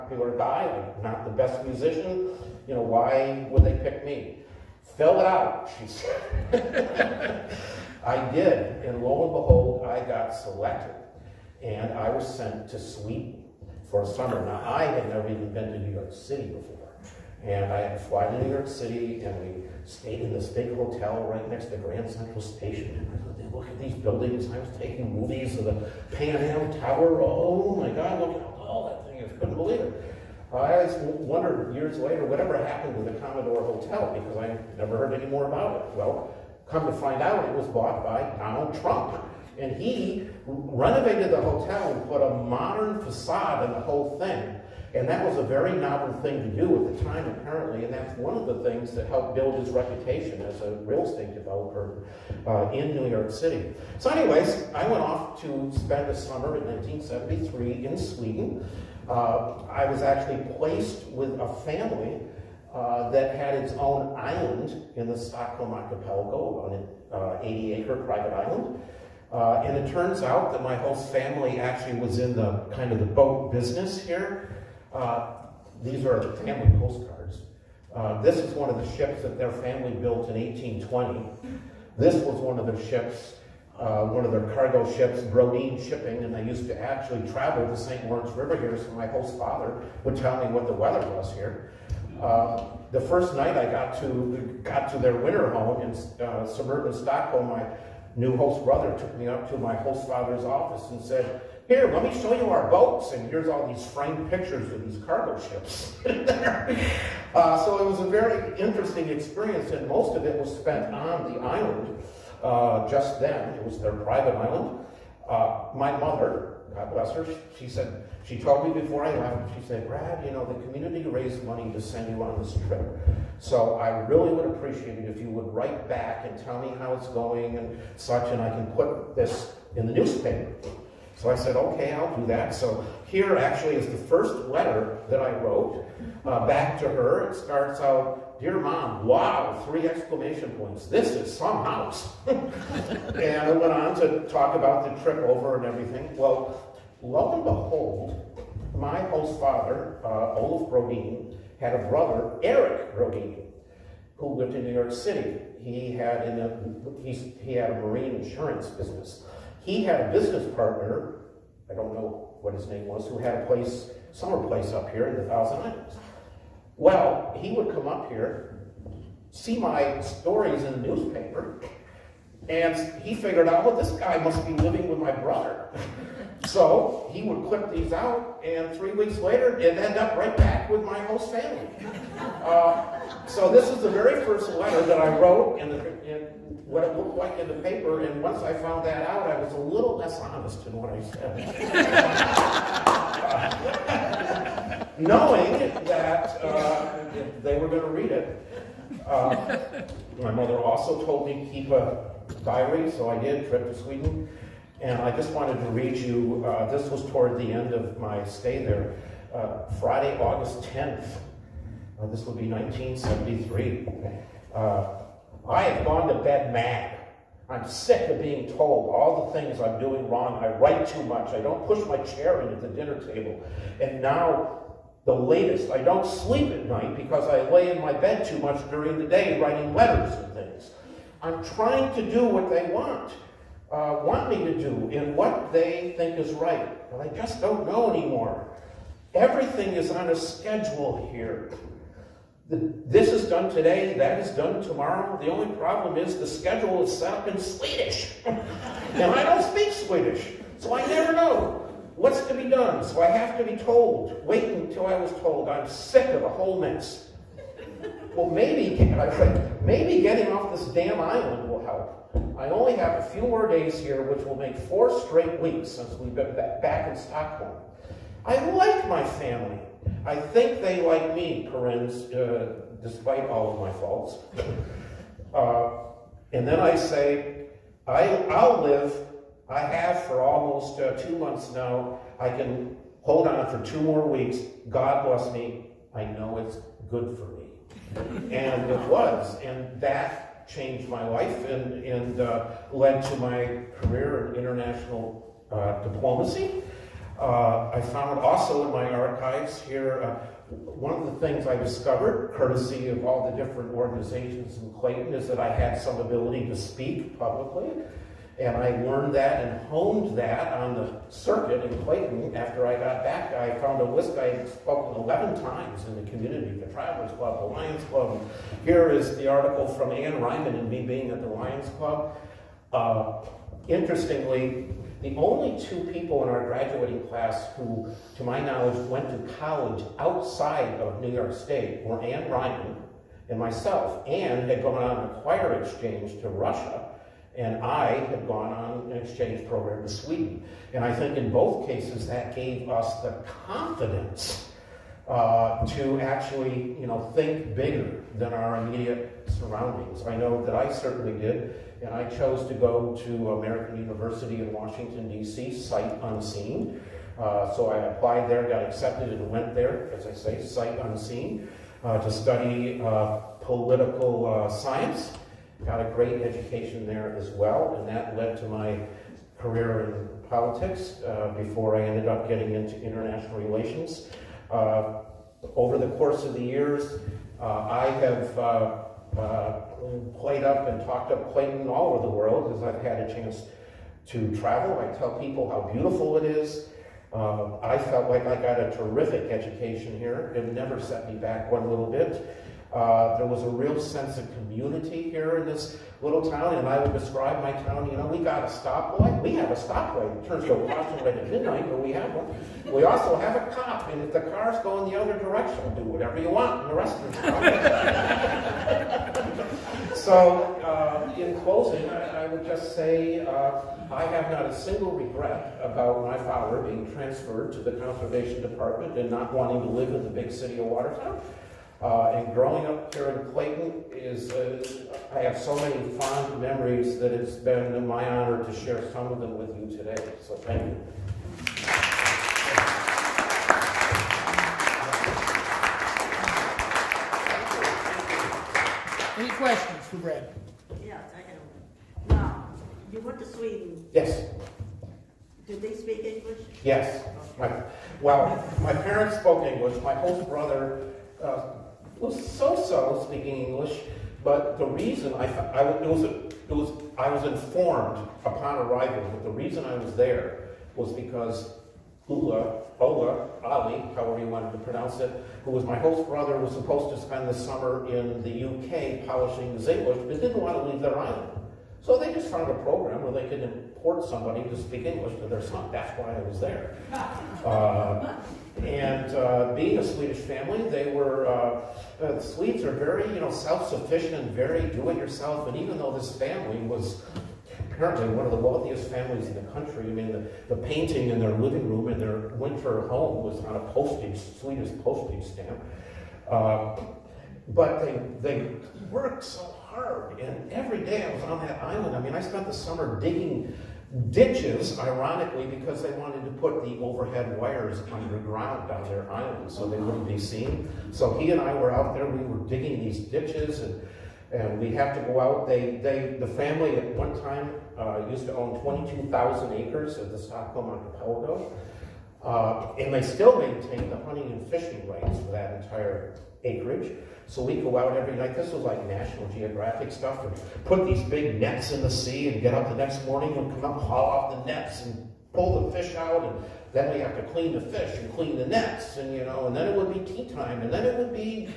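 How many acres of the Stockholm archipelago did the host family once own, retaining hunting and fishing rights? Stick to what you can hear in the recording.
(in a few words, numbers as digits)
22,000.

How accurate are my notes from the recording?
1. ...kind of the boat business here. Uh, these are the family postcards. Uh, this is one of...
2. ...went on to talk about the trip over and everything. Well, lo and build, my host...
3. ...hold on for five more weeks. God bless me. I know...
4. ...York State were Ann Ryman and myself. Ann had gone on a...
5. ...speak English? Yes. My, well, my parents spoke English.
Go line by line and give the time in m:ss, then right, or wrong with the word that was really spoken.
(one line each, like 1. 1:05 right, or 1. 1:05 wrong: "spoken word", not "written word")
1. 1:12 right
2. 2:23 wrong: "behold", not "build"
3. 4:43 wrong: "two", not "five"
4. 5:31 right
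5. 7:25 right.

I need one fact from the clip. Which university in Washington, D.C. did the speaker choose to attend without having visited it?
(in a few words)
American University.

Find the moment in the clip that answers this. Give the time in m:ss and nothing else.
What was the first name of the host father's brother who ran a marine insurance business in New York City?
2:32.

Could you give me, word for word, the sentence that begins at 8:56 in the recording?
And then we have to clean the fish and clean the nets.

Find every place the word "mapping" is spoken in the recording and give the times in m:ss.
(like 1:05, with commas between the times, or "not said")
not said.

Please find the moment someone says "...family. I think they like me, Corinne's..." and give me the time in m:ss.
4:29.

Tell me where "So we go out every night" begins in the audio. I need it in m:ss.
8:47.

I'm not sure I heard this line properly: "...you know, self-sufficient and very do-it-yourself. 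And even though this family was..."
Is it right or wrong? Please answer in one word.
right.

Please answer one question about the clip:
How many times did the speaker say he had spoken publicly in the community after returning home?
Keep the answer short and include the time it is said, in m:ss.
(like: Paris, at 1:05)
11, at 5:15.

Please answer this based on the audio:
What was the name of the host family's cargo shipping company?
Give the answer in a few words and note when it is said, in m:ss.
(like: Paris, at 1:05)
Brodin Shipping, at 1:25.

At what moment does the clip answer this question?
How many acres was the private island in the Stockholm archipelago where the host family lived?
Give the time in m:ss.
1:07.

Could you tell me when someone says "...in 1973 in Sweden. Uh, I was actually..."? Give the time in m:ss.
0:56.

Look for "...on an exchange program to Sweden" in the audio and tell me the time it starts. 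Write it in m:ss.
5:38.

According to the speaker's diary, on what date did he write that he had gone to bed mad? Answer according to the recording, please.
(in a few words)
Friday, August 10th.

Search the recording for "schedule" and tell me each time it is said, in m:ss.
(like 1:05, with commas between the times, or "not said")
4:00, 4:06.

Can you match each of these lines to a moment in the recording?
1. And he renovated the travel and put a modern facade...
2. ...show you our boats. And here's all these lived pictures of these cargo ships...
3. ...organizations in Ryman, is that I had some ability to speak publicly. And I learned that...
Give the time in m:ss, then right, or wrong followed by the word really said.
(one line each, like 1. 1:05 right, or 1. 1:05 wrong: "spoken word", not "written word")
1. 0:39 wrong: "hotel", not "travel"
2. 1:42 wrong: "framed", not "lived"
3. 5:03 wrong: "Clayton", not "Ryman".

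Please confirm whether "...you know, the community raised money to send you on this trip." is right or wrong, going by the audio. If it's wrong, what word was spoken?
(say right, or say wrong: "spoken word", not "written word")
right.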